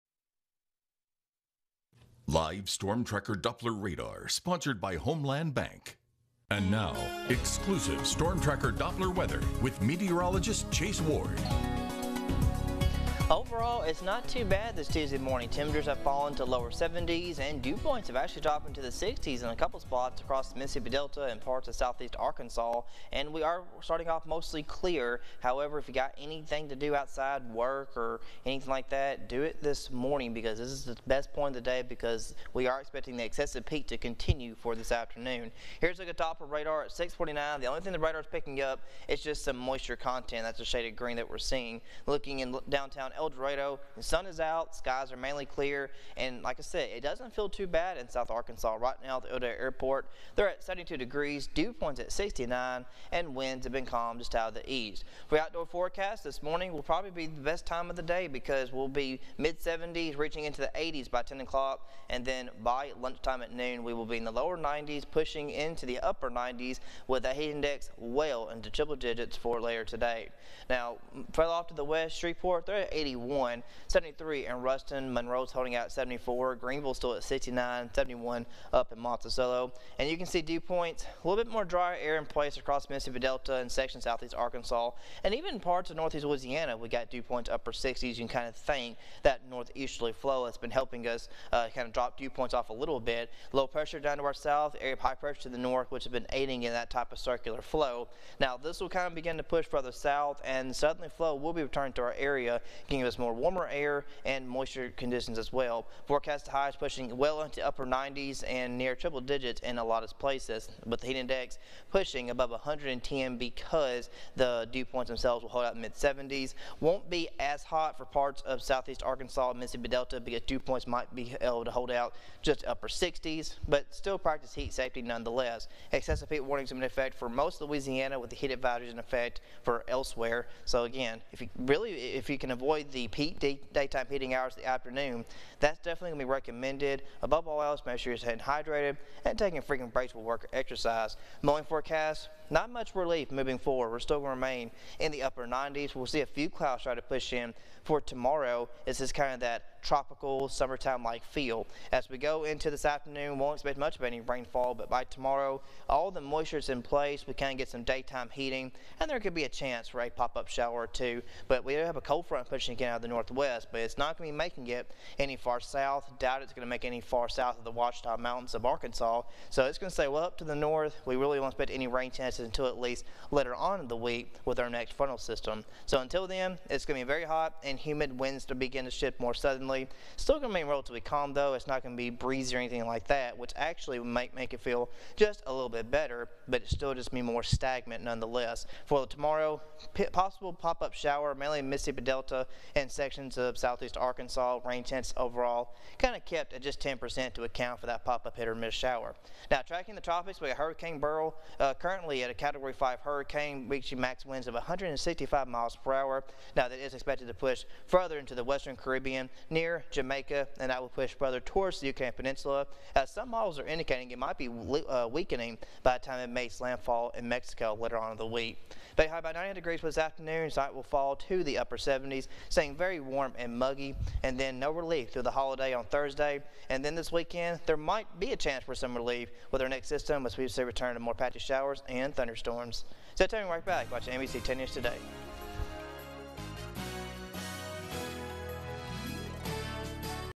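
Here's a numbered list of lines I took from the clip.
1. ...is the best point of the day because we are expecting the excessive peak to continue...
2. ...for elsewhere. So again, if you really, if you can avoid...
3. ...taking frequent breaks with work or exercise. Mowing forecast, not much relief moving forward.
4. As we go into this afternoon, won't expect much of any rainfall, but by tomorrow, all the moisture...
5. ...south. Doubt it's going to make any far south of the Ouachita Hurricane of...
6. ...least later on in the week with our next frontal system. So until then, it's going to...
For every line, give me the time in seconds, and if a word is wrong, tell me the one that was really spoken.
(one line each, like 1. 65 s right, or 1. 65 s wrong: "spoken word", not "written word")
1. 30 s right
2. 129 s right
3. 139 s right
4. 151 s right
5. 165 s wrong: "Mountains", not "Hurricane"
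6. 172 s right.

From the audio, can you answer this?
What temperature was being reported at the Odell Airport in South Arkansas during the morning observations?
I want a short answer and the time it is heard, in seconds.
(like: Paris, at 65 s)
72 degrees, at 50 s.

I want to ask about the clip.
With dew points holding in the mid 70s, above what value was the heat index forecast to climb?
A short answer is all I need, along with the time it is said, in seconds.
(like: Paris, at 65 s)
110, at 112 s.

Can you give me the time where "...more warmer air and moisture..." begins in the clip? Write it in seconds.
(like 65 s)
103 s.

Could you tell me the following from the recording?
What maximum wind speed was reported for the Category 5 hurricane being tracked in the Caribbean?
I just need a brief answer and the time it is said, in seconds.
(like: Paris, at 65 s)
165 mph, at 204 s.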